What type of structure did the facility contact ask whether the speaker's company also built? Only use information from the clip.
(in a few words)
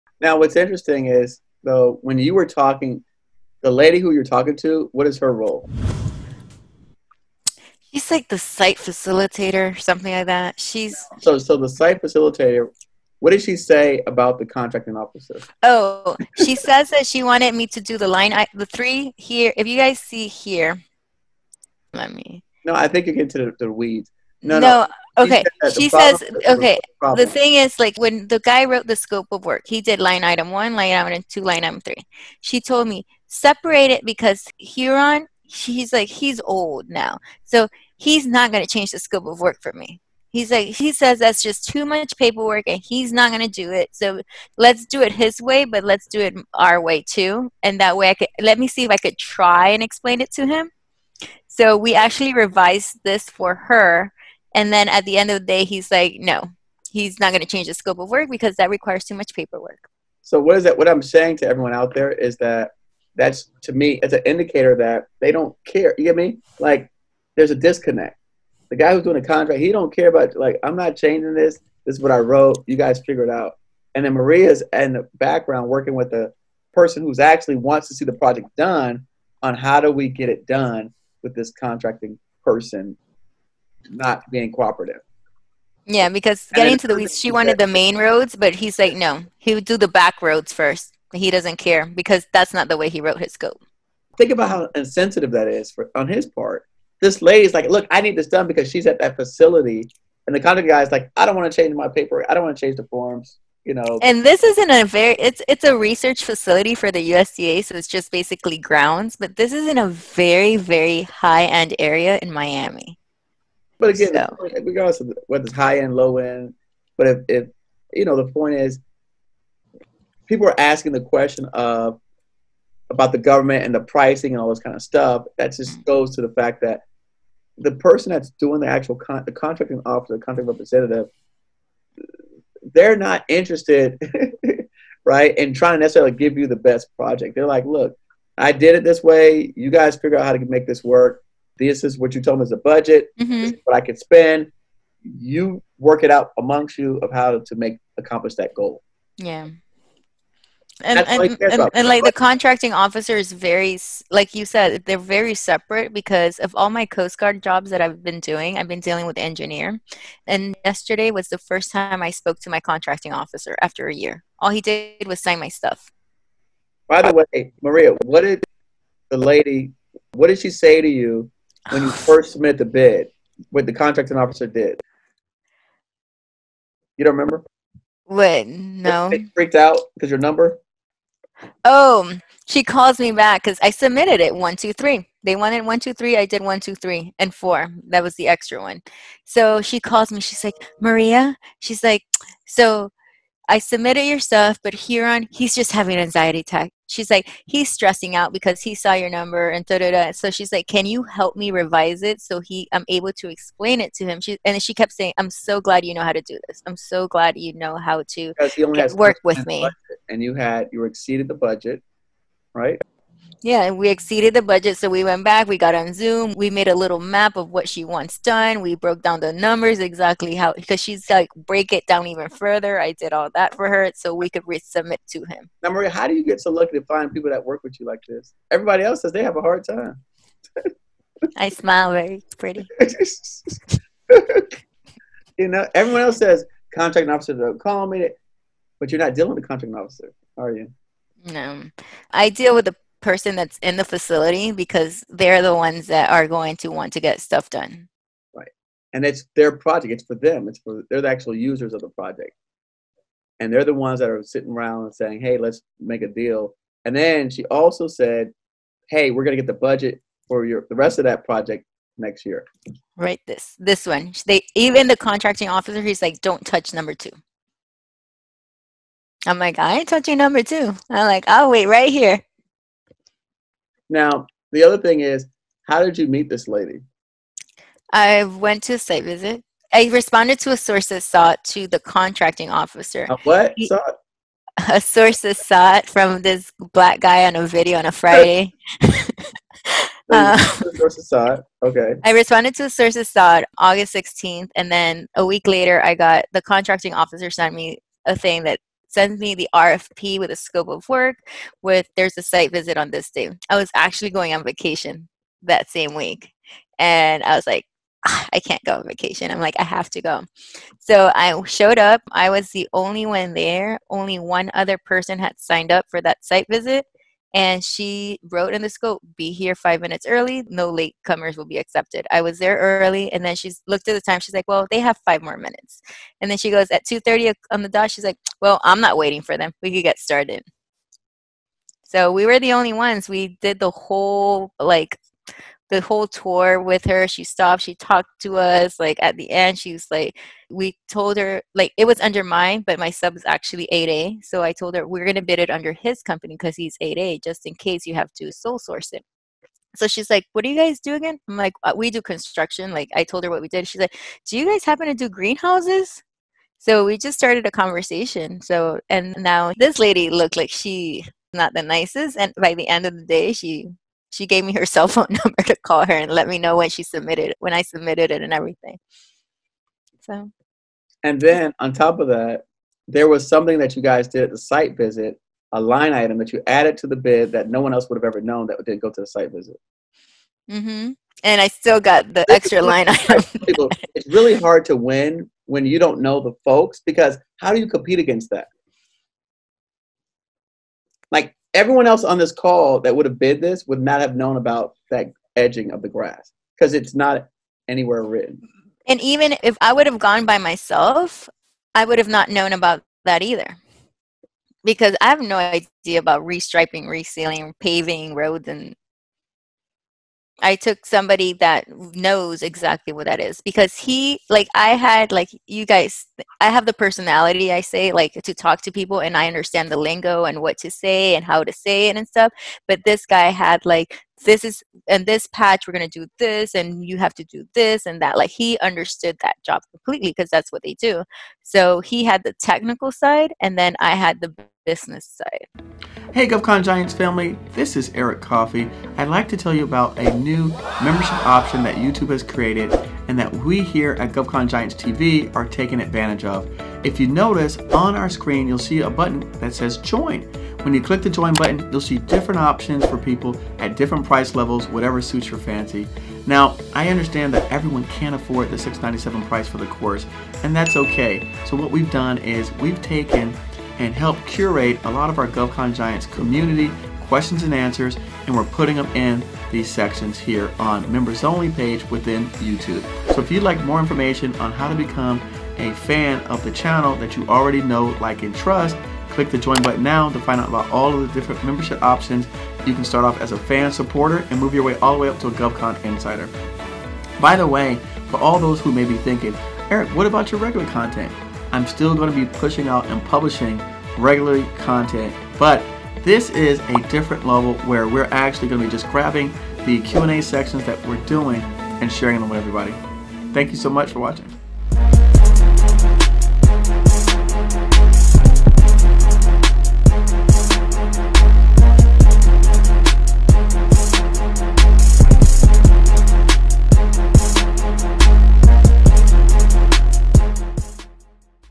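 greenhouses.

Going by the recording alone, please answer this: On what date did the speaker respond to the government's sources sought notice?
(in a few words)
August 16th.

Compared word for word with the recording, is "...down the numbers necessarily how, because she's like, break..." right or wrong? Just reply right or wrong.
wrong.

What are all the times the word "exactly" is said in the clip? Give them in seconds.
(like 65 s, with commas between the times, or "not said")
219 s, 412 s.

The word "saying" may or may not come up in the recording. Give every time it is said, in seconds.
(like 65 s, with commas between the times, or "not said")
61 s, 204 s, 254 s.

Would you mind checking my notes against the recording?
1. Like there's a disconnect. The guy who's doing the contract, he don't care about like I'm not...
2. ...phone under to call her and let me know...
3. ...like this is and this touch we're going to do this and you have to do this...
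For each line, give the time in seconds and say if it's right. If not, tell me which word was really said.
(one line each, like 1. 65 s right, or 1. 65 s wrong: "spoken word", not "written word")
1. 66 s right
2. 364 s wrong: "number", not "under"
3. 423 s wrong: "patch", not "touch".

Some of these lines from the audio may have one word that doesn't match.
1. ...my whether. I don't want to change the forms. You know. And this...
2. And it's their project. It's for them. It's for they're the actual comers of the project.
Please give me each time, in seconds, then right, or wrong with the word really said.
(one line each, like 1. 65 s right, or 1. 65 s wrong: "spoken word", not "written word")
1. 101 s wrong: "paper", not "whether"
2. 248 s wrong: "users", not "comers".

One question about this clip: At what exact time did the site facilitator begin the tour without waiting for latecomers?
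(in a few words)
2:30.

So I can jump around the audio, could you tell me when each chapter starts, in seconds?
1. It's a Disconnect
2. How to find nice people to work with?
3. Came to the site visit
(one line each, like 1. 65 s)
1. 60 s
2. 220 s
3. 305 s.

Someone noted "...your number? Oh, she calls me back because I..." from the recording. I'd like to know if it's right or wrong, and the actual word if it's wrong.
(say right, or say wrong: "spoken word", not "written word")
right.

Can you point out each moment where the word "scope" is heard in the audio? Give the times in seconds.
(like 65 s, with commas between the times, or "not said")
28 s, 38 s, 57 s, 93 s, 300 s, 318 s.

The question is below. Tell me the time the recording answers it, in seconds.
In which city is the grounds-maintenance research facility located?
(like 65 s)
112 s.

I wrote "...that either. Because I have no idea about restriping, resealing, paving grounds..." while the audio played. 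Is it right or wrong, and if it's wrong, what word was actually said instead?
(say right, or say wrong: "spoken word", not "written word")
wrong: "roads", not "grounds".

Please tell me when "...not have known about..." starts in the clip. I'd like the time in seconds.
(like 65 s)
393 s.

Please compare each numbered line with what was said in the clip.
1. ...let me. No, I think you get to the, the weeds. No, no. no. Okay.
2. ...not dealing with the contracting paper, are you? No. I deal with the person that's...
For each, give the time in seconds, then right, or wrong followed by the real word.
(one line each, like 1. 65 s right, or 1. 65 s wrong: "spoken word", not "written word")
1. 21 s right
2. 238 s wrong: "officer", not "paper".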